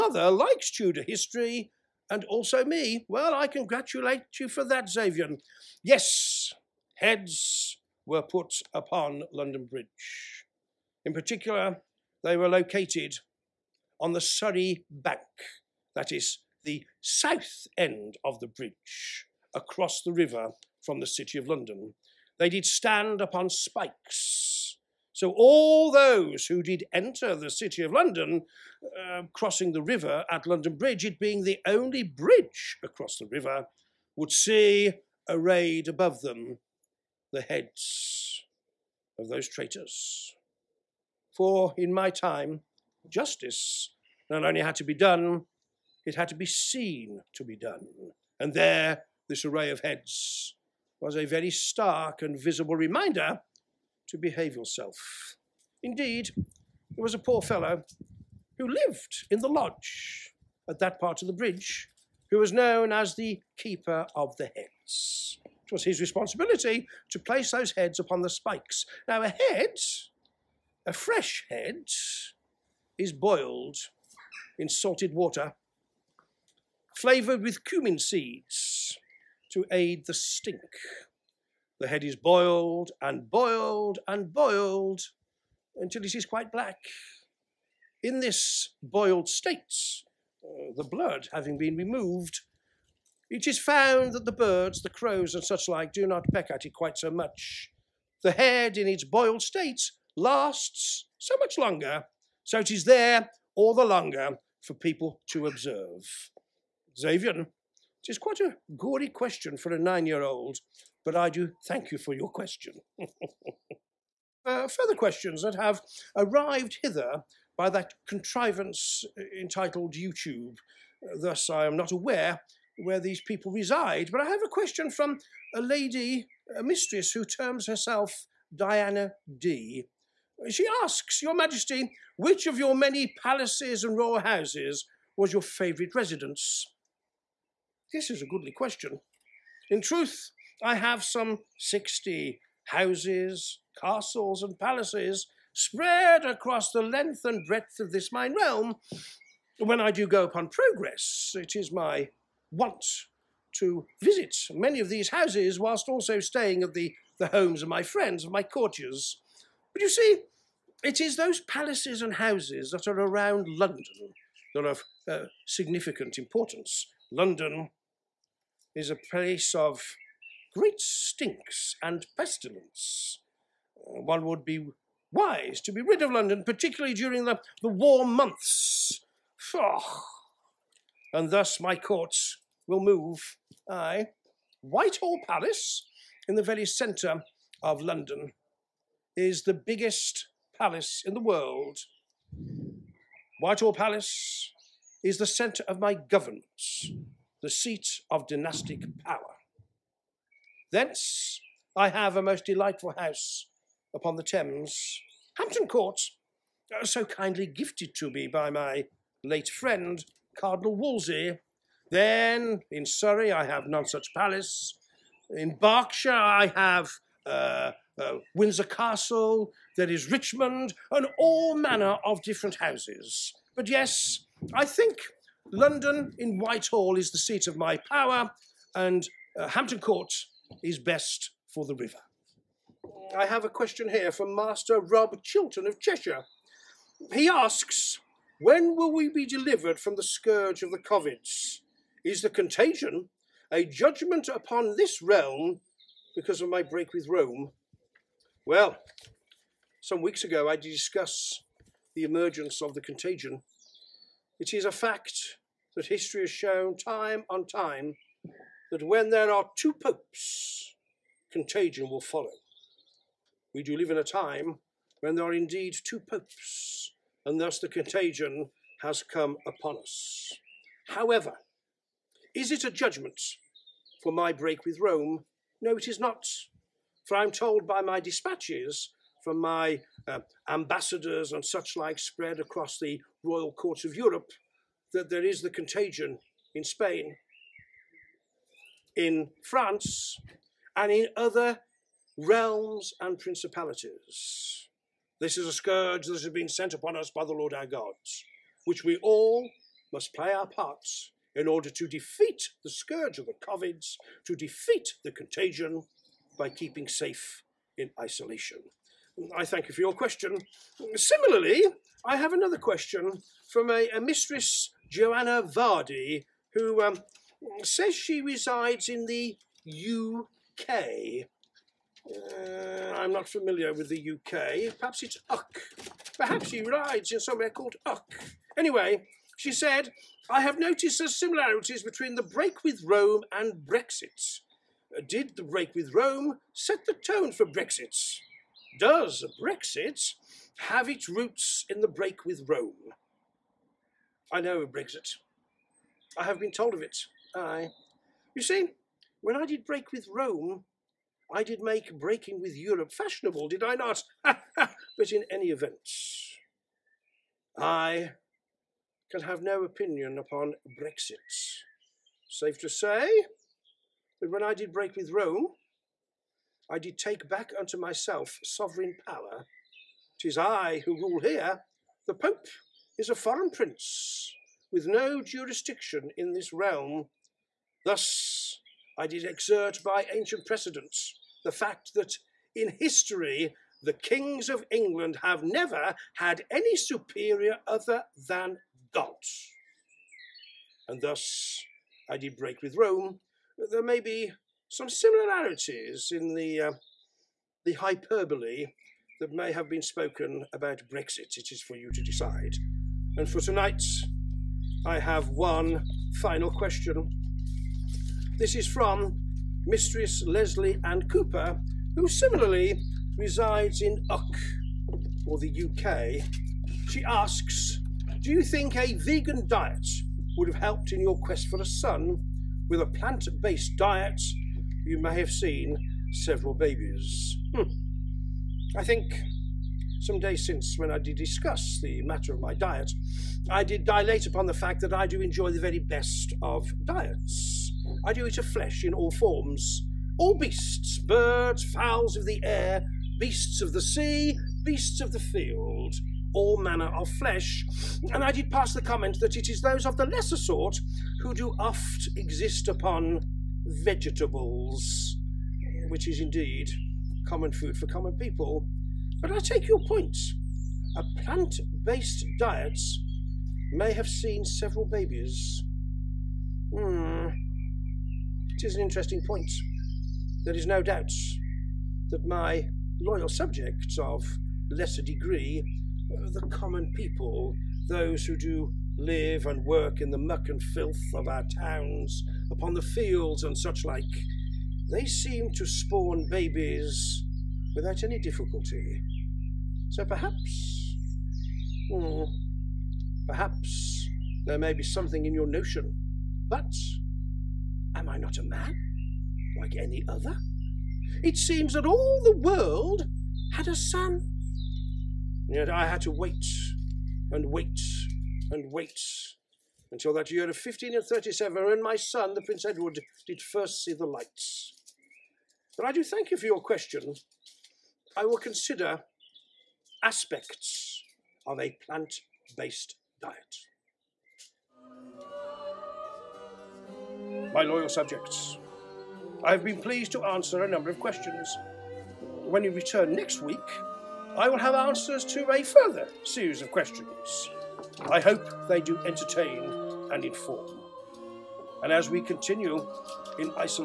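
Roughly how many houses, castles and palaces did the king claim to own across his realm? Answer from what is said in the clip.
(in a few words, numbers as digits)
60.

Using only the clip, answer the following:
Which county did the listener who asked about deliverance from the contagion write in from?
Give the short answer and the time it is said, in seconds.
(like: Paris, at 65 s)
Cheshire, at 235 s.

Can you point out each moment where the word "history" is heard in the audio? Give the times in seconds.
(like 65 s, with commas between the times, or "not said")
1 s, 255 s, 382 s.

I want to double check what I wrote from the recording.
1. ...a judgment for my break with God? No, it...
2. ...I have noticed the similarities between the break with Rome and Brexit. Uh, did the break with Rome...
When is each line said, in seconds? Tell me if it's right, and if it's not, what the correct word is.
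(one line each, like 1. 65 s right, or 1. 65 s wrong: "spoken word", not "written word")
1. 272 s wrong: "Rome", not "God"
2. 330 s right.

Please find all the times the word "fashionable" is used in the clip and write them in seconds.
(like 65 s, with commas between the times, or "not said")
352 s.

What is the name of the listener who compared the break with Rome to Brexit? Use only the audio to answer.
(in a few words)
Joanna Vardy.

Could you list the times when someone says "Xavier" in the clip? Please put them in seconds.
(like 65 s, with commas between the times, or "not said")
4 s, 106 s.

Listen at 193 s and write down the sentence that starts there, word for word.
Whitehall Palace is the centre of my government the seat of dynastic power.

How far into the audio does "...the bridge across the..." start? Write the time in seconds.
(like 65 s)
18 s.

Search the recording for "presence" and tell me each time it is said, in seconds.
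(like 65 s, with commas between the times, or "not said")
not said.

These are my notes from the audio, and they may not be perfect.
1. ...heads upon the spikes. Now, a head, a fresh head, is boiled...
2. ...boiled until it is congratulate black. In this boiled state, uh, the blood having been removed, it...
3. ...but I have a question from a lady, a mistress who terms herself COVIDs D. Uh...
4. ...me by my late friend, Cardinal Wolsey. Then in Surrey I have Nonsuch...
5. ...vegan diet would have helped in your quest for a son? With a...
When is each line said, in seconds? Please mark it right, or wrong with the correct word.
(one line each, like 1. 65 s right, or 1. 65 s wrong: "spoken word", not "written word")
1. 67 s right
2. 84 s wrong: "quite", not "congratulate"
3. 124 s wrong: "Diana", not "COVIDs"
4. 208 s right
5. 418 s right.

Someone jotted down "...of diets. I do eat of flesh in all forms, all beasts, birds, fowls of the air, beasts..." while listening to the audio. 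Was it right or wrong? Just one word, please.
right.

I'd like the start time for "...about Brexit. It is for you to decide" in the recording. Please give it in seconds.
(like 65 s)
400 s.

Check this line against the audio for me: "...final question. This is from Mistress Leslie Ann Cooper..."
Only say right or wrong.
right.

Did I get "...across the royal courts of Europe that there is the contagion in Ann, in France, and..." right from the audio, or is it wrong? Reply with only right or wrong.
wrong.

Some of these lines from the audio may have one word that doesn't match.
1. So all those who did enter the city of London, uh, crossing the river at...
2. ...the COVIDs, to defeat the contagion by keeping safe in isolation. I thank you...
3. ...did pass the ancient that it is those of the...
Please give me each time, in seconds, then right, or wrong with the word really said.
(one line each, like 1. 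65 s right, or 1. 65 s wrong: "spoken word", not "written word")
1. 25 s right
2. 303 s right
3. 448 s wrong: "comment", not "ancient".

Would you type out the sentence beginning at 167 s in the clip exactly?
London is a place of great stinks and pestilence.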